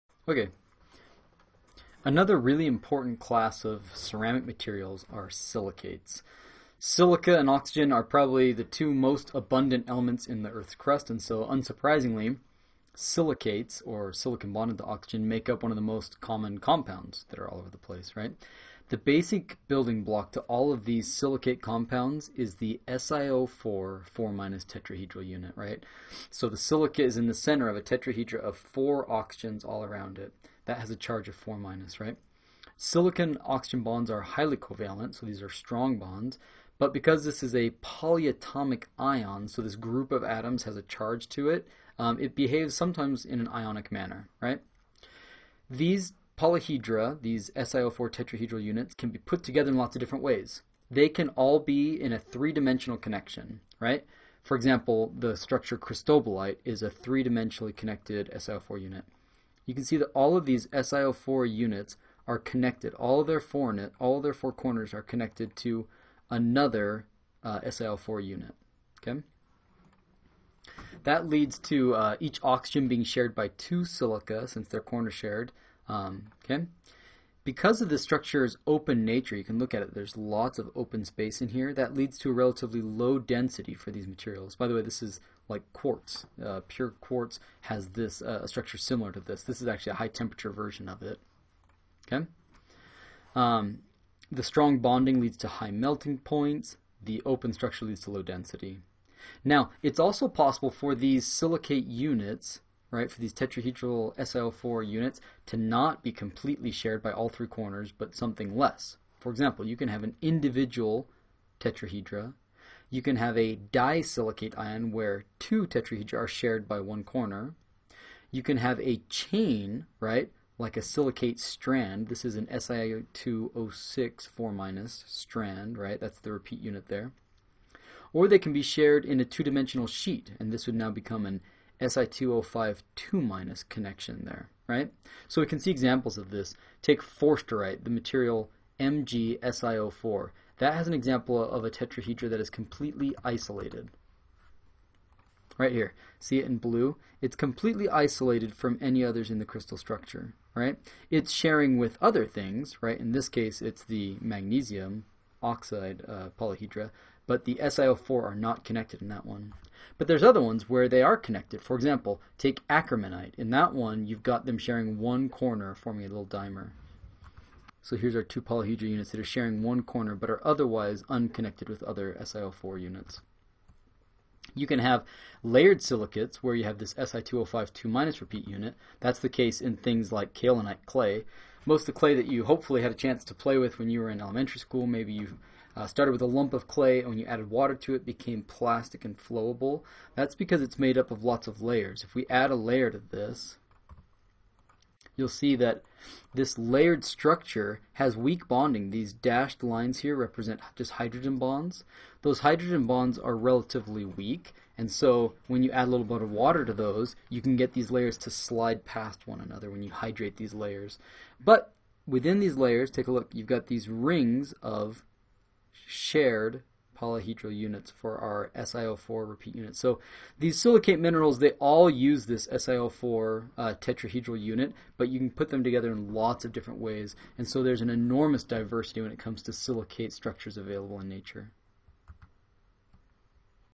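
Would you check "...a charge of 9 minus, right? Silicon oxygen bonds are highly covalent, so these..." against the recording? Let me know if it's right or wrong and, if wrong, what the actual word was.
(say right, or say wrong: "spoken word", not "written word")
wrong: "4", not "9".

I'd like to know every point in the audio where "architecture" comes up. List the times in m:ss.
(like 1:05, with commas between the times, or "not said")
not said.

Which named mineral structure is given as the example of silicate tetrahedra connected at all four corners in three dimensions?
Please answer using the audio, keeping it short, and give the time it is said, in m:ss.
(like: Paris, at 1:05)
cristobalite, at 0:55.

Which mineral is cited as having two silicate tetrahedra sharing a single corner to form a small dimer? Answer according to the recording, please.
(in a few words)
akermanite.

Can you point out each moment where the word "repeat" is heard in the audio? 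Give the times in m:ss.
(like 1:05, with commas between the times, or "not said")
2:06, 2:58, 3:39.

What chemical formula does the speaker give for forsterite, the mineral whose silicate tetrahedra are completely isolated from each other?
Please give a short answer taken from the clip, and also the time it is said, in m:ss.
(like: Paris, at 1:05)
MgSiO4, at 2:18.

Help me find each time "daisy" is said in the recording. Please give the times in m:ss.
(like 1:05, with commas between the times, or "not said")
not said.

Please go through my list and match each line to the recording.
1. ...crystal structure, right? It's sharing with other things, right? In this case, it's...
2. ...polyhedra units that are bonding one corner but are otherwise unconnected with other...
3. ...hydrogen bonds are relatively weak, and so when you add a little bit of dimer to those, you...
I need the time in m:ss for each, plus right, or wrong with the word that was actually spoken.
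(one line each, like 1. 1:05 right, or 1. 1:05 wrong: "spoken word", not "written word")
1. 2:29 right
2. 2:48 wrong: "sharing", not "bonding"
3. 3:22 wrong: "water", not "dimer".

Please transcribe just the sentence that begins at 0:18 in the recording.
The basic building block to all of these silicate compounds is the SiO4 4 minus tetrahedral unit, right?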